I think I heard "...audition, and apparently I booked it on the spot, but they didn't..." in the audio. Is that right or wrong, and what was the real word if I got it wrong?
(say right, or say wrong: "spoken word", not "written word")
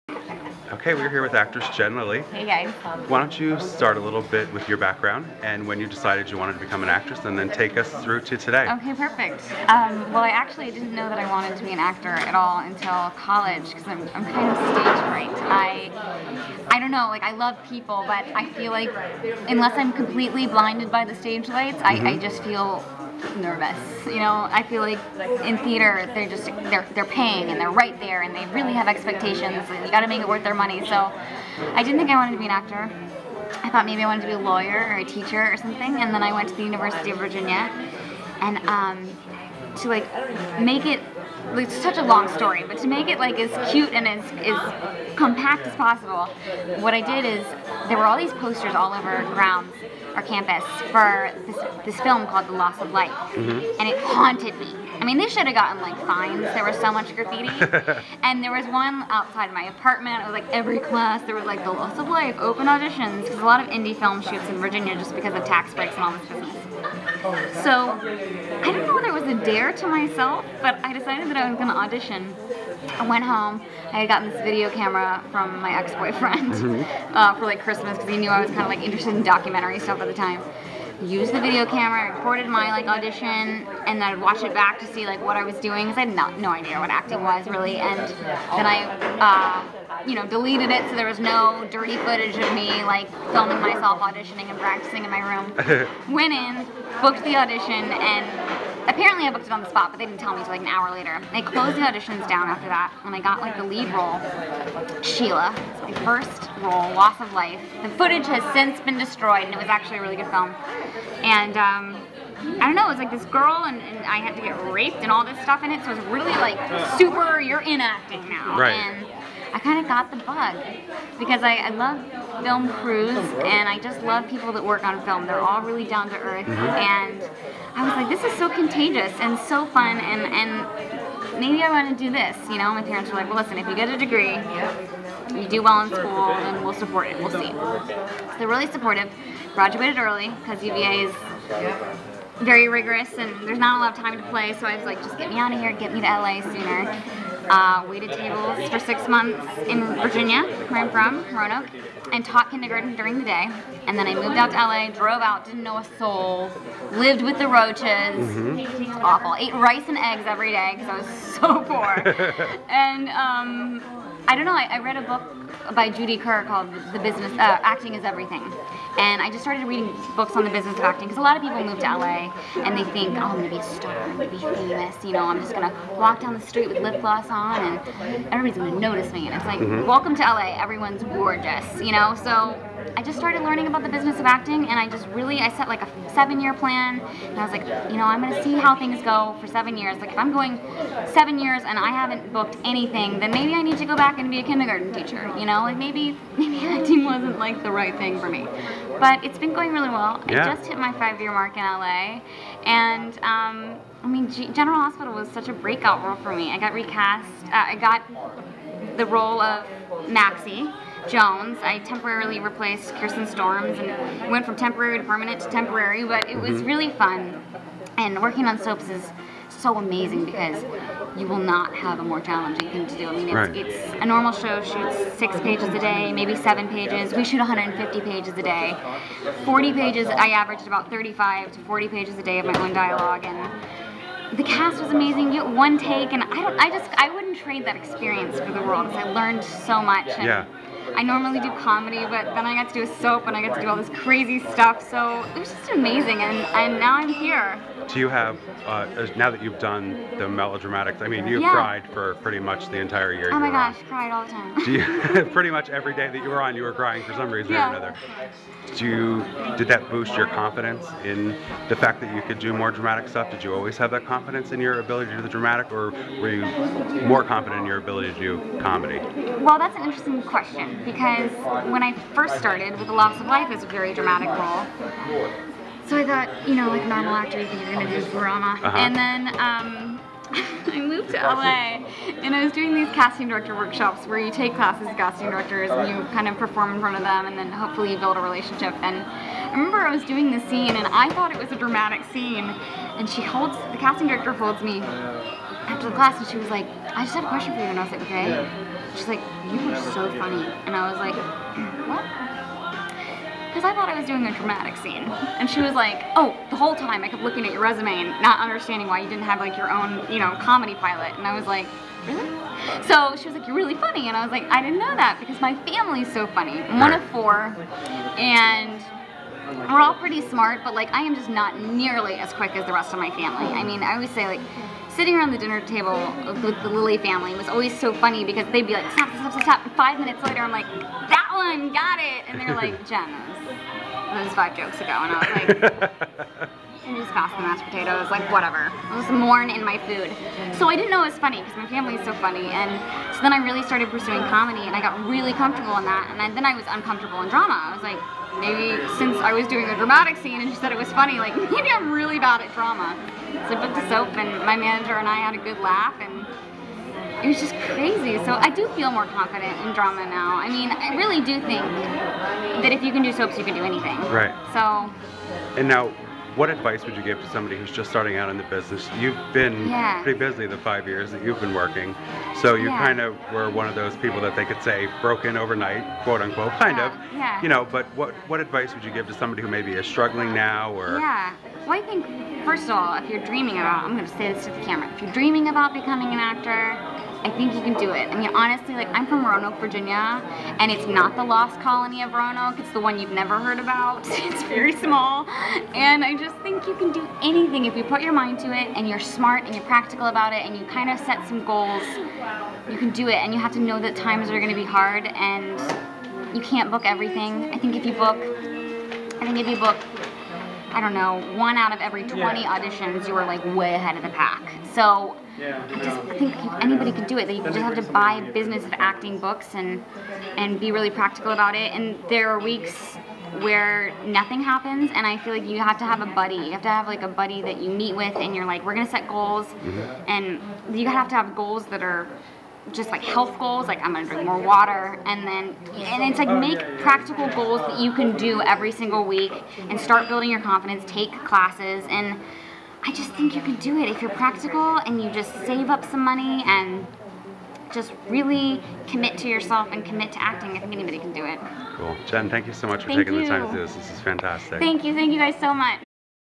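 right.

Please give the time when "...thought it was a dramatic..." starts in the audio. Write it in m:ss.
4:51.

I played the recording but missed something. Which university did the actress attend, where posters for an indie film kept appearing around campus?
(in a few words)
University of Virginia.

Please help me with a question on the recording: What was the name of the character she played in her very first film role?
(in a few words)
Sheila.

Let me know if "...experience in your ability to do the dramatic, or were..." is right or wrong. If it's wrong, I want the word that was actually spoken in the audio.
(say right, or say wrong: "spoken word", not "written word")
wrong: "confidence", not "experience".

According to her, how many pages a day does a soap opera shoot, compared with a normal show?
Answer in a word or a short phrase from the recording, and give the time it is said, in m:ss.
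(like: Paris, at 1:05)
150, at 3:47.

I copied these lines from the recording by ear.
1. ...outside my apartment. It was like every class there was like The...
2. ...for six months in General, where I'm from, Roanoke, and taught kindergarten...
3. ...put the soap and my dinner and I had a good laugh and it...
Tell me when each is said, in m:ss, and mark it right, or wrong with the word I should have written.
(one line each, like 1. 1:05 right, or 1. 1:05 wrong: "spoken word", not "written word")
1. 0:59 right
2. 2:28 wrong: "Virginia", not "General"
3. 5:53 wrong: "manager", not "dinner".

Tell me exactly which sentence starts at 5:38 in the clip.
I was mourn in my food.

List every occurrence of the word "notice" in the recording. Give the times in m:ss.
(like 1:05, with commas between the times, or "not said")
2:58.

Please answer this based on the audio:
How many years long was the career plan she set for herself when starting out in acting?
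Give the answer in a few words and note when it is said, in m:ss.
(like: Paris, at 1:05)
7, at 3:06.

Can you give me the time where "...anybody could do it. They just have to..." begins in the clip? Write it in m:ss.
6:56.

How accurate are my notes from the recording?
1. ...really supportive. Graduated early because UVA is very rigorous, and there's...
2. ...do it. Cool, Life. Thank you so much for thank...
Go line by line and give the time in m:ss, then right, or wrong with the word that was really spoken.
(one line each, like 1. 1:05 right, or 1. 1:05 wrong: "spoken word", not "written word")
1. 2:18 right
2. 7:31 wrong: "Jen", not "Life".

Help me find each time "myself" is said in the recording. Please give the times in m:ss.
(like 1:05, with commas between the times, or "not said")
1:09, 1:33.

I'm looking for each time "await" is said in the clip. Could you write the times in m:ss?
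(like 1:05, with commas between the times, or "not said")
not said.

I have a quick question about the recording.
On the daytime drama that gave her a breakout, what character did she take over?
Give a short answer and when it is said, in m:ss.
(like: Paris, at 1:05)
Maxie Jones, at 3:30.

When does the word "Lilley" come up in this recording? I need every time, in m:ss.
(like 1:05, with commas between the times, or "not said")
0:01, 5:26.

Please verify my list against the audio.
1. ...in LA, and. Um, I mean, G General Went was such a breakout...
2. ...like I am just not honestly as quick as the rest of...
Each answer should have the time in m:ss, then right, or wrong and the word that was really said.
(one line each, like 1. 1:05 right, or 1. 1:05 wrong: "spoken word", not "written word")
1. 3:21 wrong: "Hospital", not "Went"
2. 5:20 wrong: "nearly", not "honestly".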